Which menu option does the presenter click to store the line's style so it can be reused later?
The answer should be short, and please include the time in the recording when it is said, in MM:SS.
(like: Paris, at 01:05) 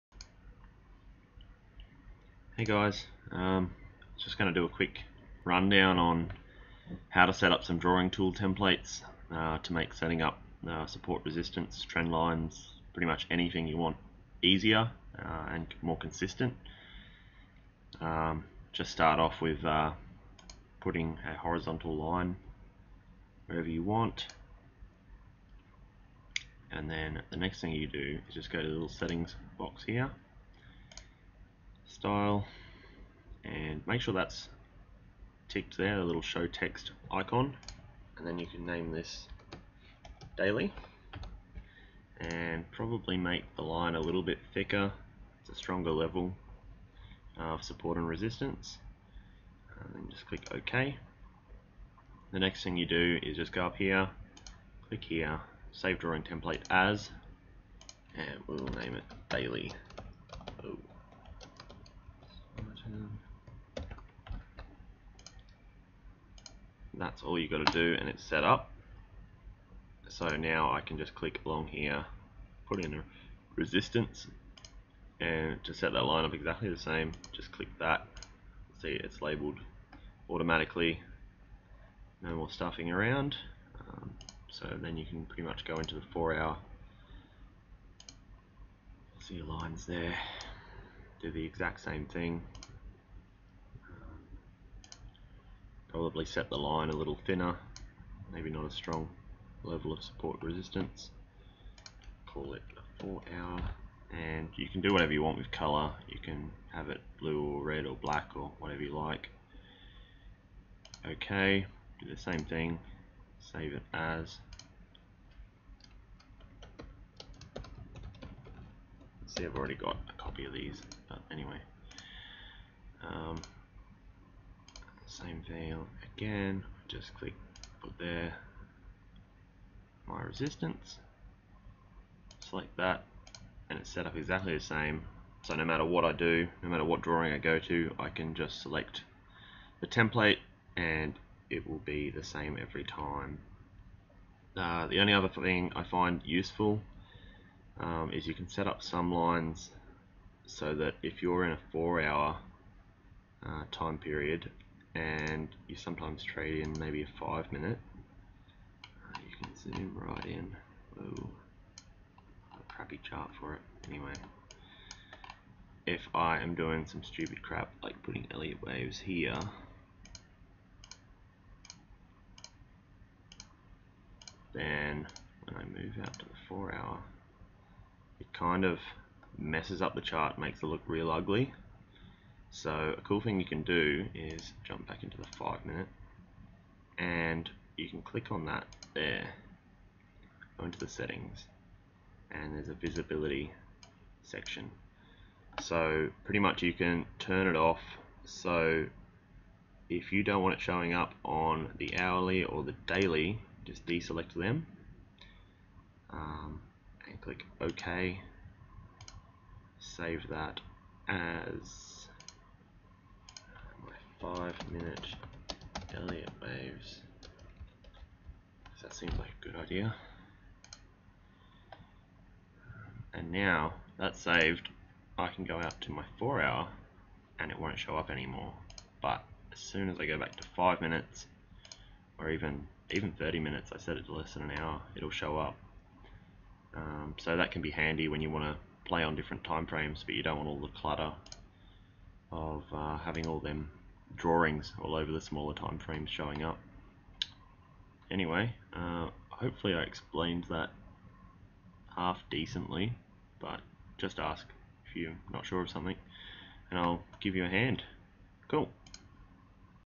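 save drawing template as, at 00:55.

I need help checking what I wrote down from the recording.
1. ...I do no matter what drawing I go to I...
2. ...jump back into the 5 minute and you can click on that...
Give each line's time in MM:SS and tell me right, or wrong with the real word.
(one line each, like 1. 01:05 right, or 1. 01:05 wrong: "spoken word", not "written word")
1. 02:16 right
2. 03:04 right.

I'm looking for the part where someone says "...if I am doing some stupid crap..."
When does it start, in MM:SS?
02:45.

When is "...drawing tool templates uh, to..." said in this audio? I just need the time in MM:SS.
00:07.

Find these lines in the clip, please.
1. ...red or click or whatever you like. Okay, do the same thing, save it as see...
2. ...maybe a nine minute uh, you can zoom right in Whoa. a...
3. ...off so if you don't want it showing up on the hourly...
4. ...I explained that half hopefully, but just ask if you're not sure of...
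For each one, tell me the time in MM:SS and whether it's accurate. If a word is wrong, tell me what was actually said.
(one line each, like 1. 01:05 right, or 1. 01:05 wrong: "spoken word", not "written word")
1. 01:47 wrong: "black", not "click"
2. 02:36 wrong: "five", not "nine"
3. 03:17 right
4. 04:09 wrong: "decently", not "hopefully".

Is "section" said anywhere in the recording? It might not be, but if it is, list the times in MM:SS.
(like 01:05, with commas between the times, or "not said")
03:14.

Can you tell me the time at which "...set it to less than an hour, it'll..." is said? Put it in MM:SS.
03:53.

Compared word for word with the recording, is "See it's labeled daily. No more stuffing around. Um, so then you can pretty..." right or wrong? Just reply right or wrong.
wrong.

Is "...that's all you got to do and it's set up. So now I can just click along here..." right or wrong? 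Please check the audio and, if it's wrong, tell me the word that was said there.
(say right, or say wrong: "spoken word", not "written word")
right.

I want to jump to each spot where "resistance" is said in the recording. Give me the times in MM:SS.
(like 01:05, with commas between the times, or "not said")
00:11, 00:48, 01:13, 01:40, 02:10.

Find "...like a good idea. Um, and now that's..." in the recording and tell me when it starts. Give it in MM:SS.
03:39.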